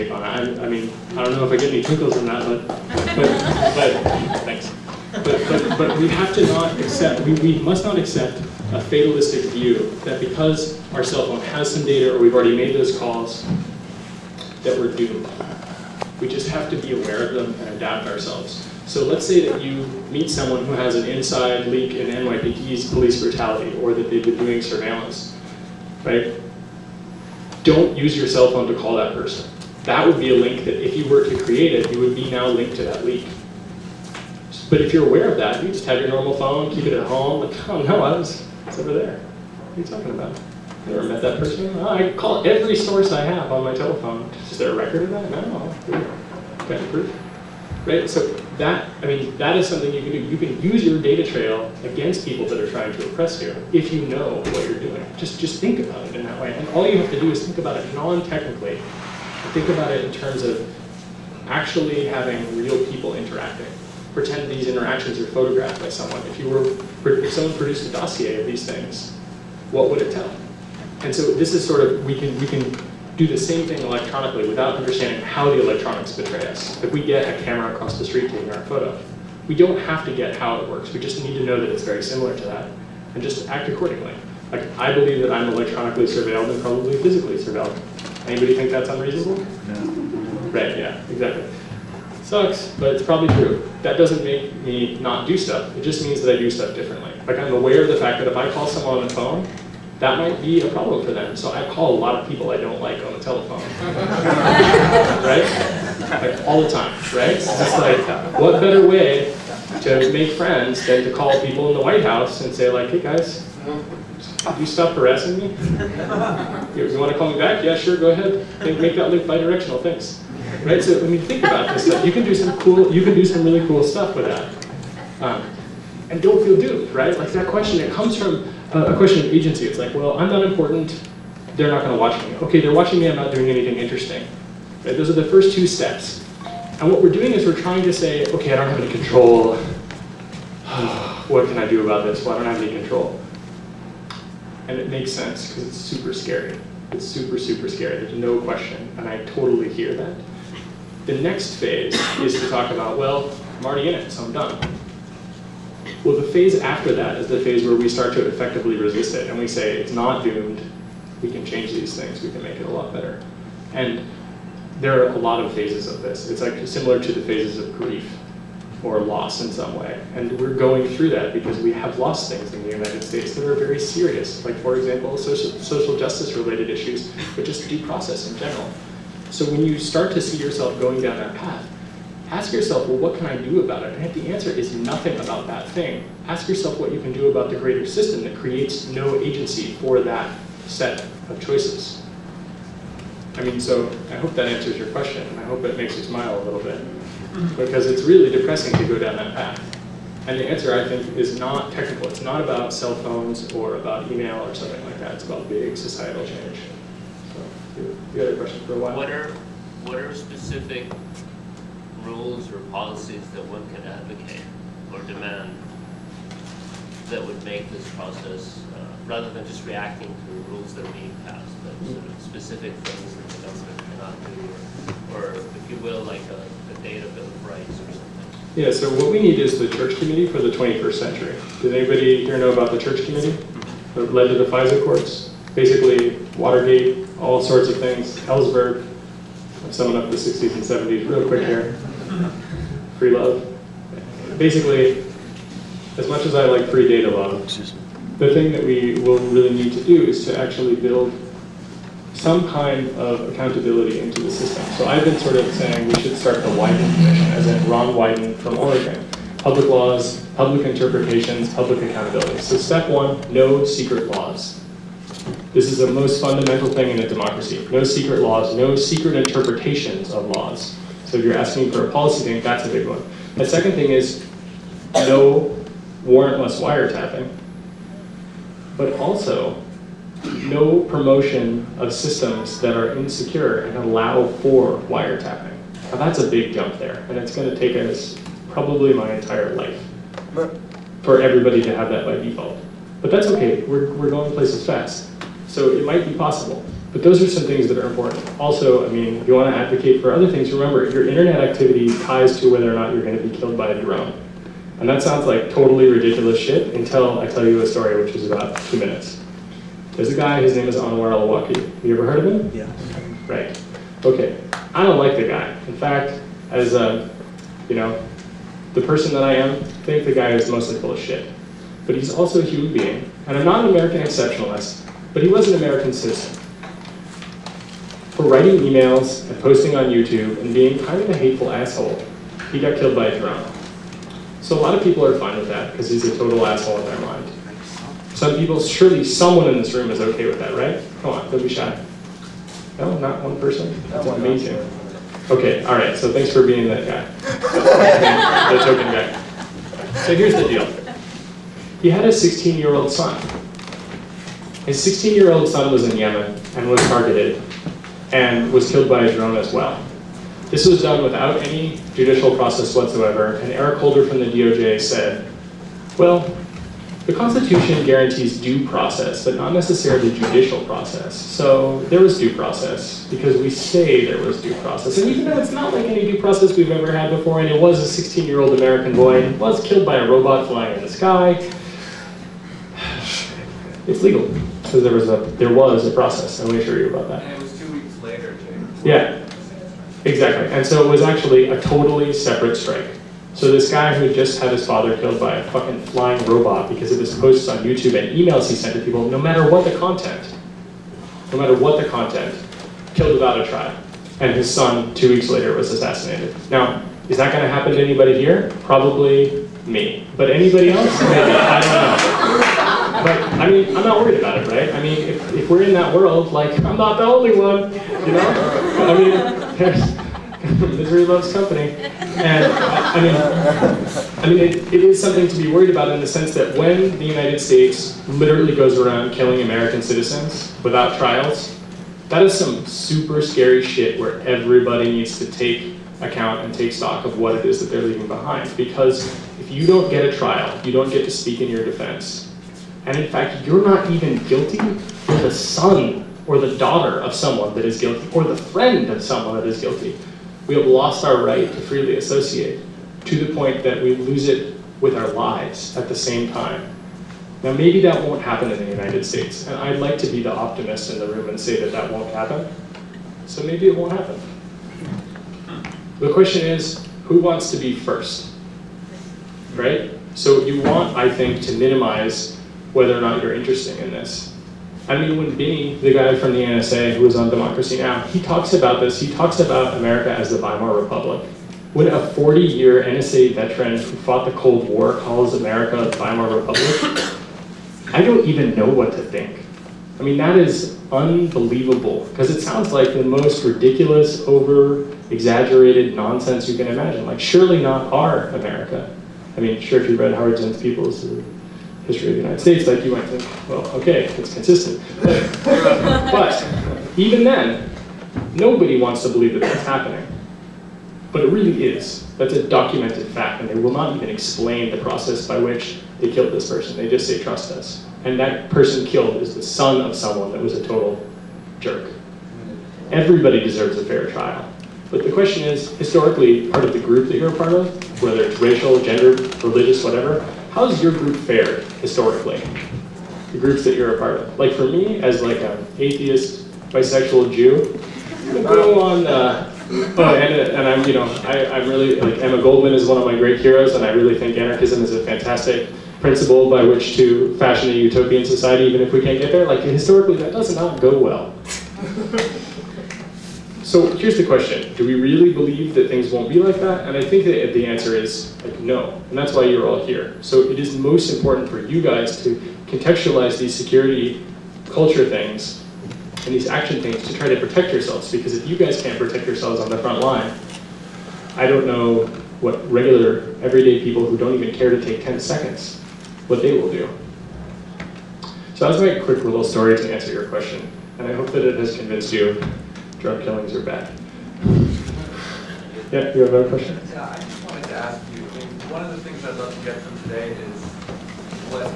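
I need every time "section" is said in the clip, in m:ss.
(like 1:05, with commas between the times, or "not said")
not said.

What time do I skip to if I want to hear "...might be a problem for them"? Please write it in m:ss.
1:40.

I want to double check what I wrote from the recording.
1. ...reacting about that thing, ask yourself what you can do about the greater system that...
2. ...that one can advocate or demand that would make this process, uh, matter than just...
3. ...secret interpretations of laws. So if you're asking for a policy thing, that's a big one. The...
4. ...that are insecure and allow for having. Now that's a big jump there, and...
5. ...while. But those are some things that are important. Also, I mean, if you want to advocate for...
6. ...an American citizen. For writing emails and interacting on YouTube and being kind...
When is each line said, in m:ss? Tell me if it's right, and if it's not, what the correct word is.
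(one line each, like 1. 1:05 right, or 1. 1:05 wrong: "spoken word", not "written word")
1. 3:04 wrong: "nothing", not "reacting"
2. 3:33 wrong: "rather", not "matter"
3. 4:28 right
4. 4:42 wrong: "wiretapping", not "having"
5. 4:56 wrong: "possible", not "while"
6. 5:25 wrong: "posting", not "interacting".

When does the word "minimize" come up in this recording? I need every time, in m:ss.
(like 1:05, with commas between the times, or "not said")
7:51.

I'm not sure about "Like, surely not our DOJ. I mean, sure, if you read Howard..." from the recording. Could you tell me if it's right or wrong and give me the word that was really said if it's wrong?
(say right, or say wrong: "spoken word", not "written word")
wrong: "America", not "DOJ".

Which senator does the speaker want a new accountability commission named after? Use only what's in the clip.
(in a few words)
Ron Wyden.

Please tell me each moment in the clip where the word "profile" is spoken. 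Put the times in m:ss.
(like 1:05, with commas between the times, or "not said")
not said.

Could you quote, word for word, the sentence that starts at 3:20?
And the answer, I think, is not technical.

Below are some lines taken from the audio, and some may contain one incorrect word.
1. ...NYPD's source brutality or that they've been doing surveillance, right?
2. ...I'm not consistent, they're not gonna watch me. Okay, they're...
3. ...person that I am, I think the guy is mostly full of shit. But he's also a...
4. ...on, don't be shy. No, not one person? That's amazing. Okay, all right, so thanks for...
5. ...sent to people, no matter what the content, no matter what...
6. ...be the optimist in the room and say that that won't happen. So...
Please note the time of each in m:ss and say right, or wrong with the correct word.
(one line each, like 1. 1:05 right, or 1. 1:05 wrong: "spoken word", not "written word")
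1. 0:22 wrong: "police", not "source"
2. 2:10 wrong: "important", not "consistent"
3. 5:18 right
4. 5:41 right
5. 6:38 right
6. 7:40 right.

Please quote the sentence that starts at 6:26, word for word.
I going to assure you about that.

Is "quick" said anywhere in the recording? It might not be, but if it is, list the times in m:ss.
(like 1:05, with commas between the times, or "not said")
4:01, 9:39.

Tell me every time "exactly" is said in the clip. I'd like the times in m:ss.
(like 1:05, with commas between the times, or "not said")
1:31, 6:30.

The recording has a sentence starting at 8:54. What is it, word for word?
Like for me, as like an atheist, bisexual Jew, i go on.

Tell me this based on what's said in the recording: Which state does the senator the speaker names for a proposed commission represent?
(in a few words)
Oregon.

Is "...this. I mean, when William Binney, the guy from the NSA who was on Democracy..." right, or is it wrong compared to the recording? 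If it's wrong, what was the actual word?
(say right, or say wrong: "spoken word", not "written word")
right.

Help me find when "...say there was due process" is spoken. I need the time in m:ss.
6:13.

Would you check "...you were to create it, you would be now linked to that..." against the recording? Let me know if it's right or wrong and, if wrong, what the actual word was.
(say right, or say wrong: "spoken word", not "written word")
right.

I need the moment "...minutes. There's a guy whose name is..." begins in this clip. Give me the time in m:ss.
5:08.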